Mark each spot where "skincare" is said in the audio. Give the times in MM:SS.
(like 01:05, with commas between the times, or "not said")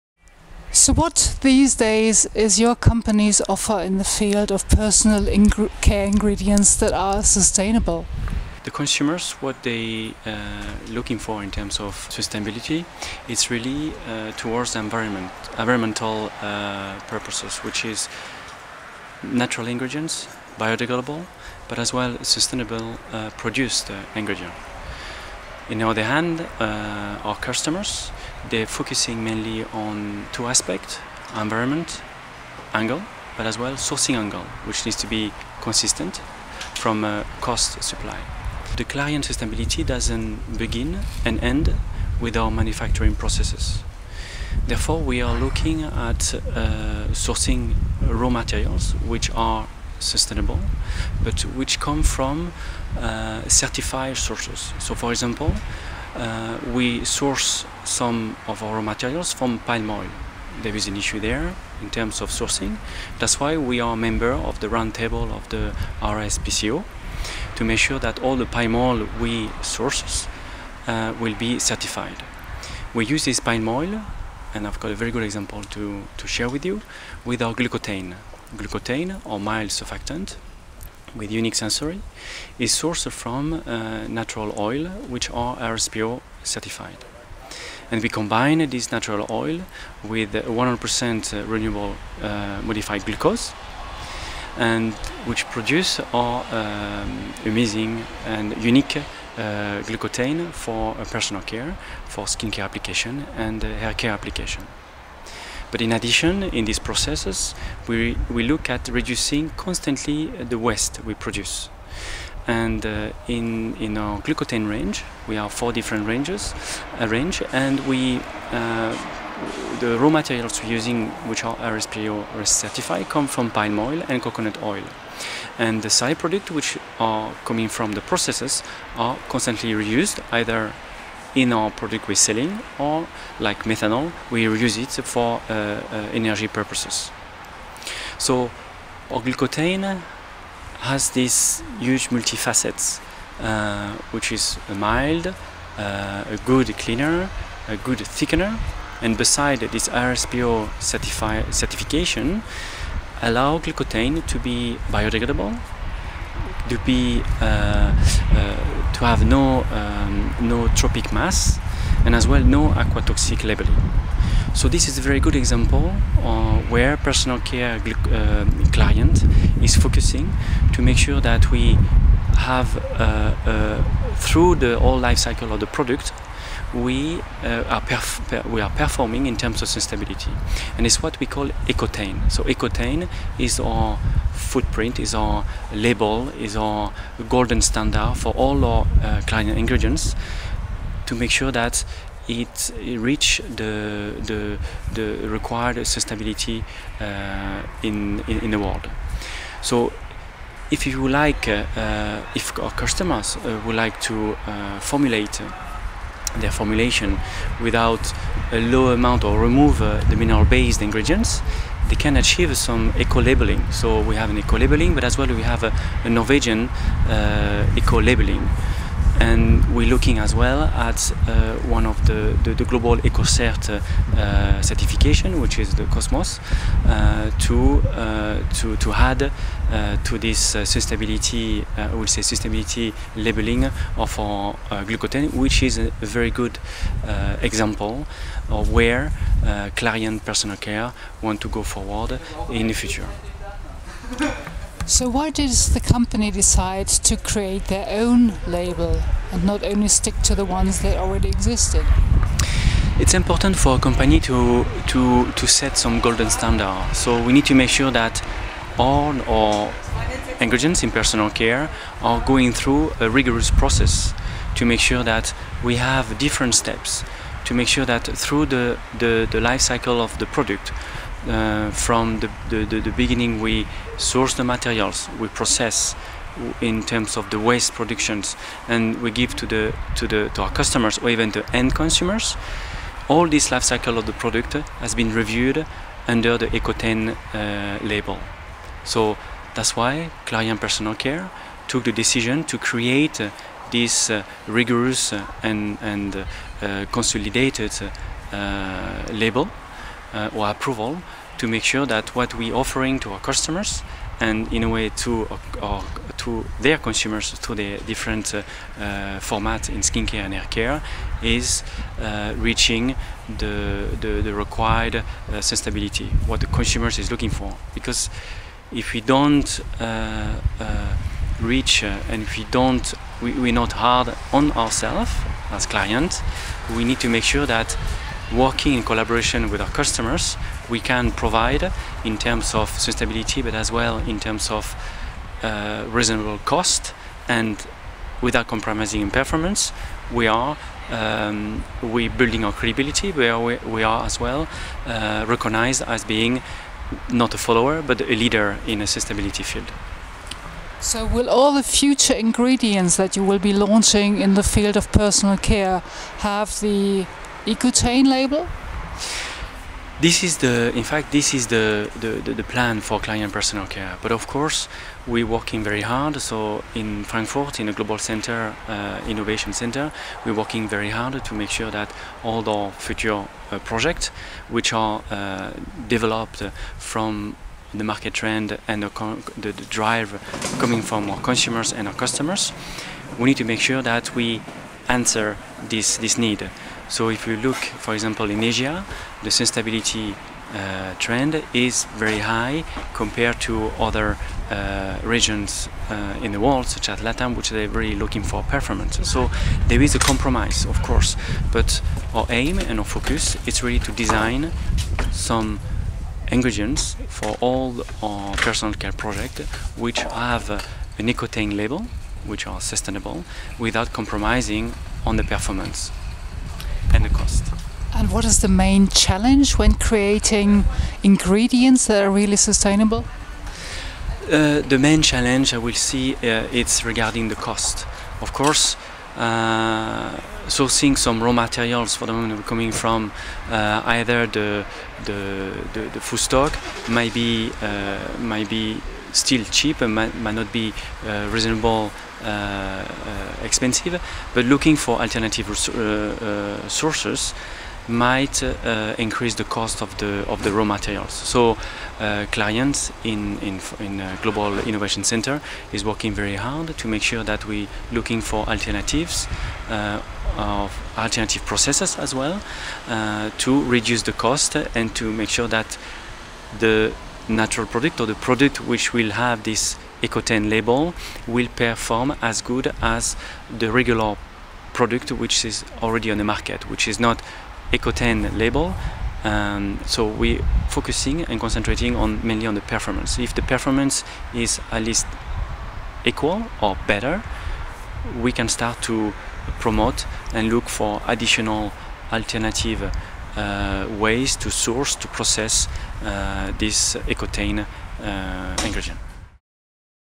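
01:42, 05:09.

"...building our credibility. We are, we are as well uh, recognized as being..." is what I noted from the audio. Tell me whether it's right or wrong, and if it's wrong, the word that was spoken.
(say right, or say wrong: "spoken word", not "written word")
right.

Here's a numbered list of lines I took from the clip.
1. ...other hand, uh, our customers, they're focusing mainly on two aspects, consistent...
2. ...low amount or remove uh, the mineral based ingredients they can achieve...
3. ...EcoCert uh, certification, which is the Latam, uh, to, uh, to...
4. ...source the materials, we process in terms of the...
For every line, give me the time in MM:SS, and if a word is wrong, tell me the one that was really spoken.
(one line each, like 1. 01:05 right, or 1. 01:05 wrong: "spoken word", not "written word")
1. 00:25 wrong: "environment", not "consistent"
2. 03:28 right
3. 03:42 wrong: "Cosmos", not "Latam"
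4. 04:33 right.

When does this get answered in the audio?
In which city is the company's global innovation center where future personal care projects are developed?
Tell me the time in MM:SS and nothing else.
06:07.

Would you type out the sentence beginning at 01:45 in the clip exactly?
But in addition, in these processes, we, we look at reducing constantly the waste we produce.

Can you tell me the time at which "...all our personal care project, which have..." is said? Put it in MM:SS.
06:47.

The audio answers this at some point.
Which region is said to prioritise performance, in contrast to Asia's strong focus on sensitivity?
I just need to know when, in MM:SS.
06:36.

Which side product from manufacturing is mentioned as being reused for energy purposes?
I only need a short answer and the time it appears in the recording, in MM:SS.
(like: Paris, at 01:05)
Methanol, at 02:13.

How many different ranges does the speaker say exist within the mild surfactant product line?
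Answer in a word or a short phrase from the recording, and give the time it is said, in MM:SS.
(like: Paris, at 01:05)
4, at 01:55.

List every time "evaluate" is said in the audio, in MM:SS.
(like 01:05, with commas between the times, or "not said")
not said.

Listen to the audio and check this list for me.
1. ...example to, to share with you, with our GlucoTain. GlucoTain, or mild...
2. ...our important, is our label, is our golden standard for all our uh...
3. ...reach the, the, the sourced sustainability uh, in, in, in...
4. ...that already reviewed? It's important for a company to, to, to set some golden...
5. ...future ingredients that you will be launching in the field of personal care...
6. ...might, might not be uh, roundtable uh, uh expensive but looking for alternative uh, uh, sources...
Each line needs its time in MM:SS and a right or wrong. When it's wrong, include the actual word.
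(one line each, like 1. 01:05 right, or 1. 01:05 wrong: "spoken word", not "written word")
1. 01:15 right
2. 03:03 wrong: "footprint", not "important"
3. 03:12 wrong: "required", not "sourced"
4. 04:10 wrong: "existed", not "reviewed"
5. 05:51 right
6. 07:19 wrong: "reasonable", not "roundtable".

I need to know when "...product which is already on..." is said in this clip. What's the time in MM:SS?
07:54.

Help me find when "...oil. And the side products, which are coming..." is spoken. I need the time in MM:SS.
02:04.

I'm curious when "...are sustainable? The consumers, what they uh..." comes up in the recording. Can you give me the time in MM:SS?
00:06.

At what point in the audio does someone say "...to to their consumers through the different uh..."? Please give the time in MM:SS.
05:04.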